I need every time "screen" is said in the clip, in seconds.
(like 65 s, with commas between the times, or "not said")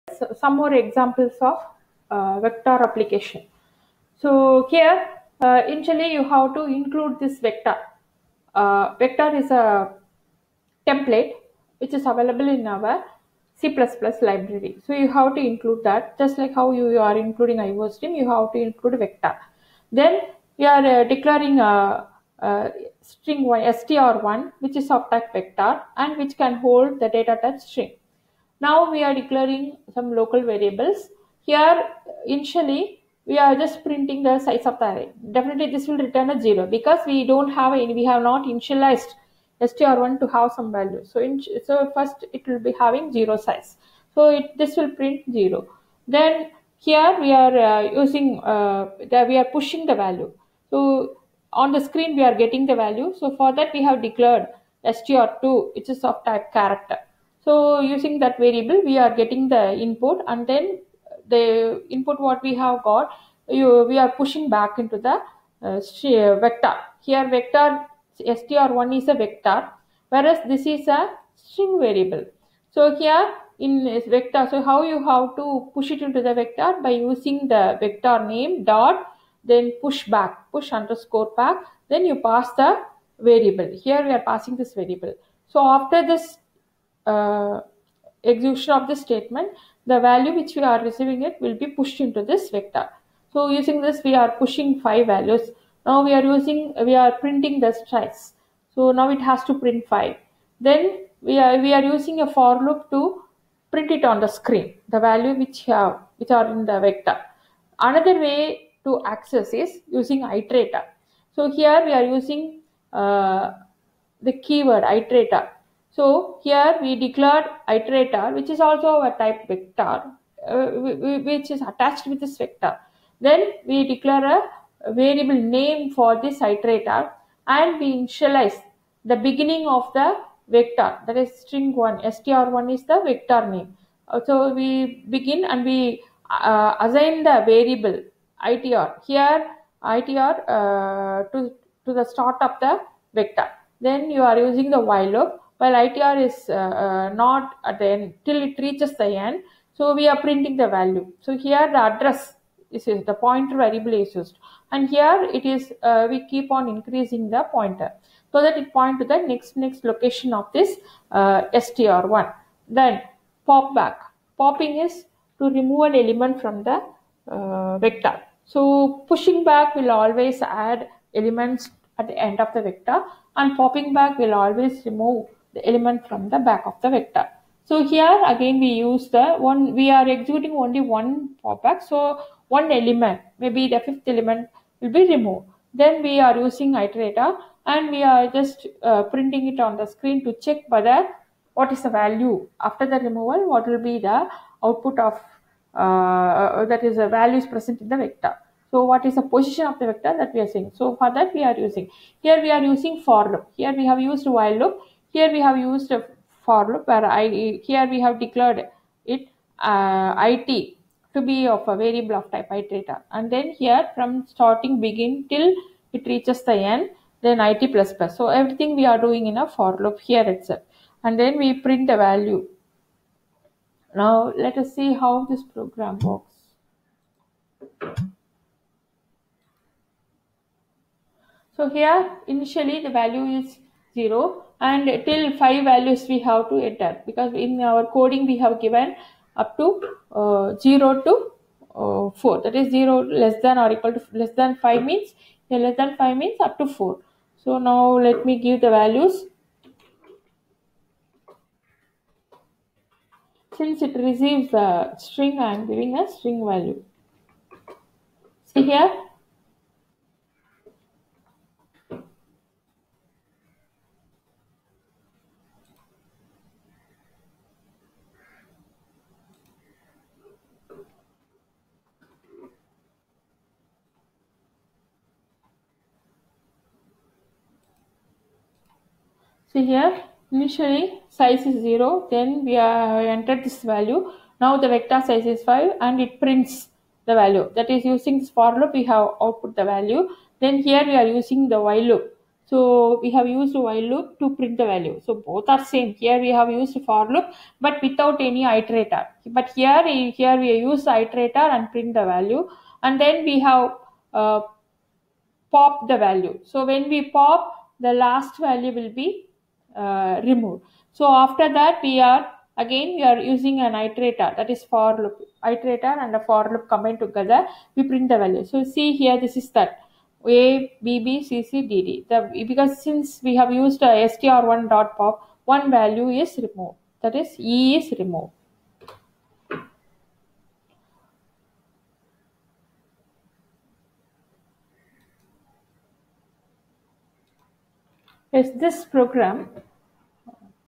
51 s, 104 s, 189 s.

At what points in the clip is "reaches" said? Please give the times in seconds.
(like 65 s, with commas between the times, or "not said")
148 s, 216 s.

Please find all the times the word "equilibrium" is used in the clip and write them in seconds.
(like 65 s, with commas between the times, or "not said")
not said.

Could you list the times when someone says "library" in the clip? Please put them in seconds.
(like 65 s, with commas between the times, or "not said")
14 s.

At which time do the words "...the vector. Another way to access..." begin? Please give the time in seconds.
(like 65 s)
106 s.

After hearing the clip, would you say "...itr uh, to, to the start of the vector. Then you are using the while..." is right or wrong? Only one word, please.
right.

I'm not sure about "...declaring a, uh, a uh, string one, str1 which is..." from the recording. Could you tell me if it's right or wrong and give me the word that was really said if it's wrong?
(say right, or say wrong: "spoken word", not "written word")
right.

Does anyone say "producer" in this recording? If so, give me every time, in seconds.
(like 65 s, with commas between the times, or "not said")
not said.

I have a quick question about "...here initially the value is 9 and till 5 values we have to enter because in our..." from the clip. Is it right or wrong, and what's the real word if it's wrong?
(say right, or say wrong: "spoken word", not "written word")
wrong: "0", not "9".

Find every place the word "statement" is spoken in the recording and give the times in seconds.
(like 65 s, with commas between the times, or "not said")
88 s.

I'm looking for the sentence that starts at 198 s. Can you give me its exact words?
So what is the position of the vector that we are seeing?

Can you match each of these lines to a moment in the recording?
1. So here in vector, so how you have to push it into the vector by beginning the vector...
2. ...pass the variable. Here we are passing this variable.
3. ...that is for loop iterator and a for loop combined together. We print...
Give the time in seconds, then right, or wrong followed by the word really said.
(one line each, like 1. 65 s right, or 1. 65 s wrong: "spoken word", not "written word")
1. 72 s wrong: "using", not "beginning"
2. 82 s right
3. 314 s right.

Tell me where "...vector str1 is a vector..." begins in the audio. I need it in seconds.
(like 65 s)
67 s.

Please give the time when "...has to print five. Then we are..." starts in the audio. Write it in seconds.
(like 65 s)
99 s.